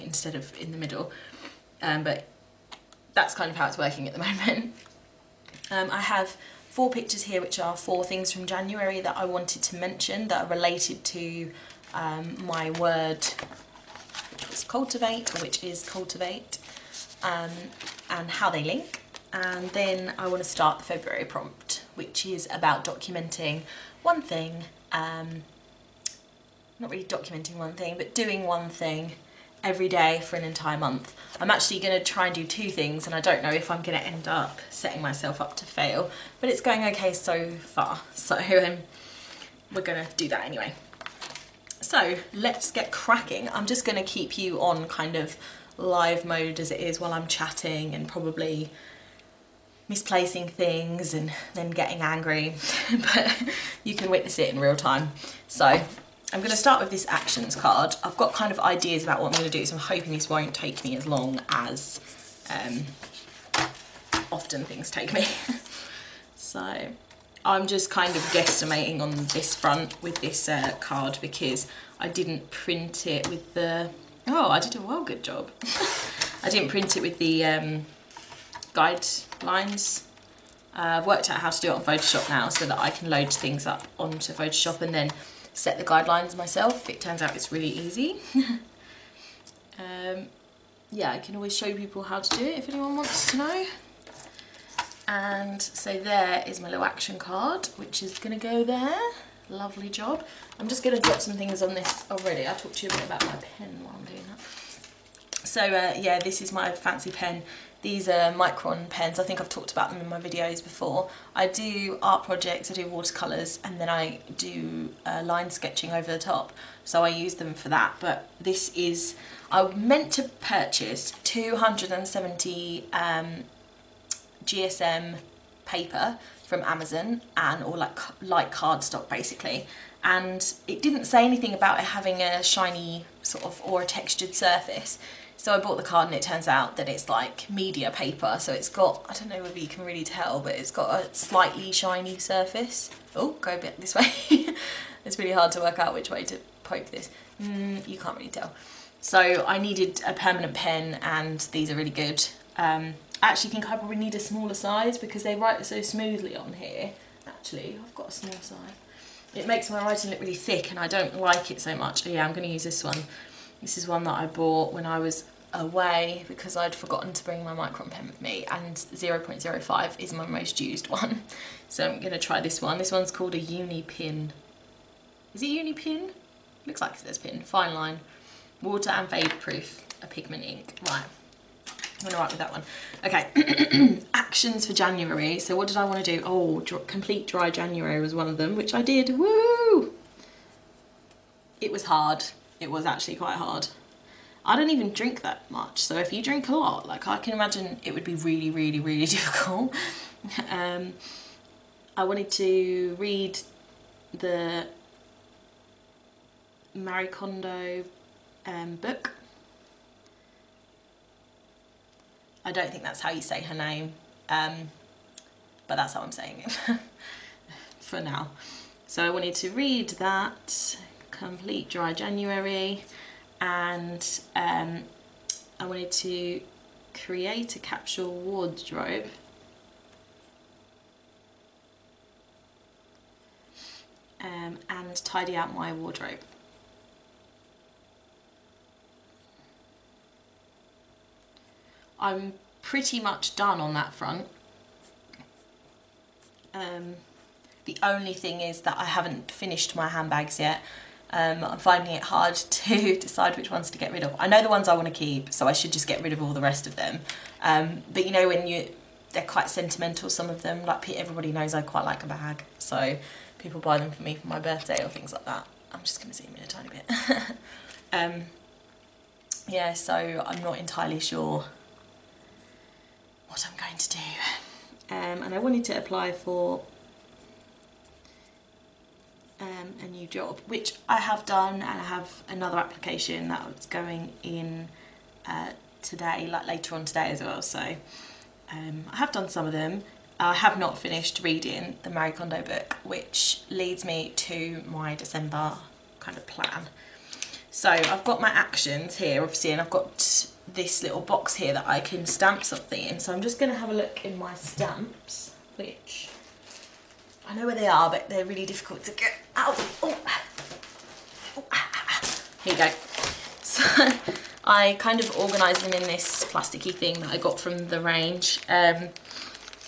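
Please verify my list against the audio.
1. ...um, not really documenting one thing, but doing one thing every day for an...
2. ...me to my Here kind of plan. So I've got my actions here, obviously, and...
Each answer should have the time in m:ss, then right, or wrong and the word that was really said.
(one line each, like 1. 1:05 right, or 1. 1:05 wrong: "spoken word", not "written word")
1. 0:24 right
2. 4:53 wrong: "December", not "Here".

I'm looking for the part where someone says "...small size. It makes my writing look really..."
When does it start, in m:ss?
2:38.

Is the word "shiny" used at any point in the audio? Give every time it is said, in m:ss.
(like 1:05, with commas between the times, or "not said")
2:12, 2:21.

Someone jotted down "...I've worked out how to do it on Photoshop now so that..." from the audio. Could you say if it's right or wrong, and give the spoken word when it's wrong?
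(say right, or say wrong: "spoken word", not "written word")
right.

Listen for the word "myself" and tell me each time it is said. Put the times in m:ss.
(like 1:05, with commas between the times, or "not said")
0:35, 1:26.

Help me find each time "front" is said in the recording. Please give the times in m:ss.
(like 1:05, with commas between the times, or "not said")
1:09, 4:03.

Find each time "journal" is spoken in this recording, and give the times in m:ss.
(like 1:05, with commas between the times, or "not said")
not said.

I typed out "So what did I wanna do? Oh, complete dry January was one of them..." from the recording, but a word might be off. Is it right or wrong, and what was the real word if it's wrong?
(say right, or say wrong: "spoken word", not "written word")
right.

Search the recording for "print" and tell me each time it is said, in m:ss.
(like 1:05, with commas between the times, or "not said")
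1:12, 1:16.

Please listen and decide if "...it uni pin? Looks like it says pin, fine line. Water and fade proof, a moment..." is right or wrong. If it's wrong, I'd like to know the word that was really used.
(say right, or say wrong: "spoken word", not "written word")
wrong: "pigment", not "moment".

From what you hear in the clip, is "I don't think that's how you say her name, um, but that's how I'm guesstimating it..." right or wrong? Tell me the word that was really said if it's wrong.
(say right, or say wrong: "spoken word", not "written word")
wrong: "saying", not "guesstimating".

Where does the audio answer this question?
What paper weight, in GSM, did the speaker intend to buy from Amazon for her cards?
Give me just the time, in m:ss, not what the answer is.
2:01.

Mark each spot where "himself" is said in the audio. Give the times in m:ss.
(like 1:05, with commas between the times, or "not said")
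not said.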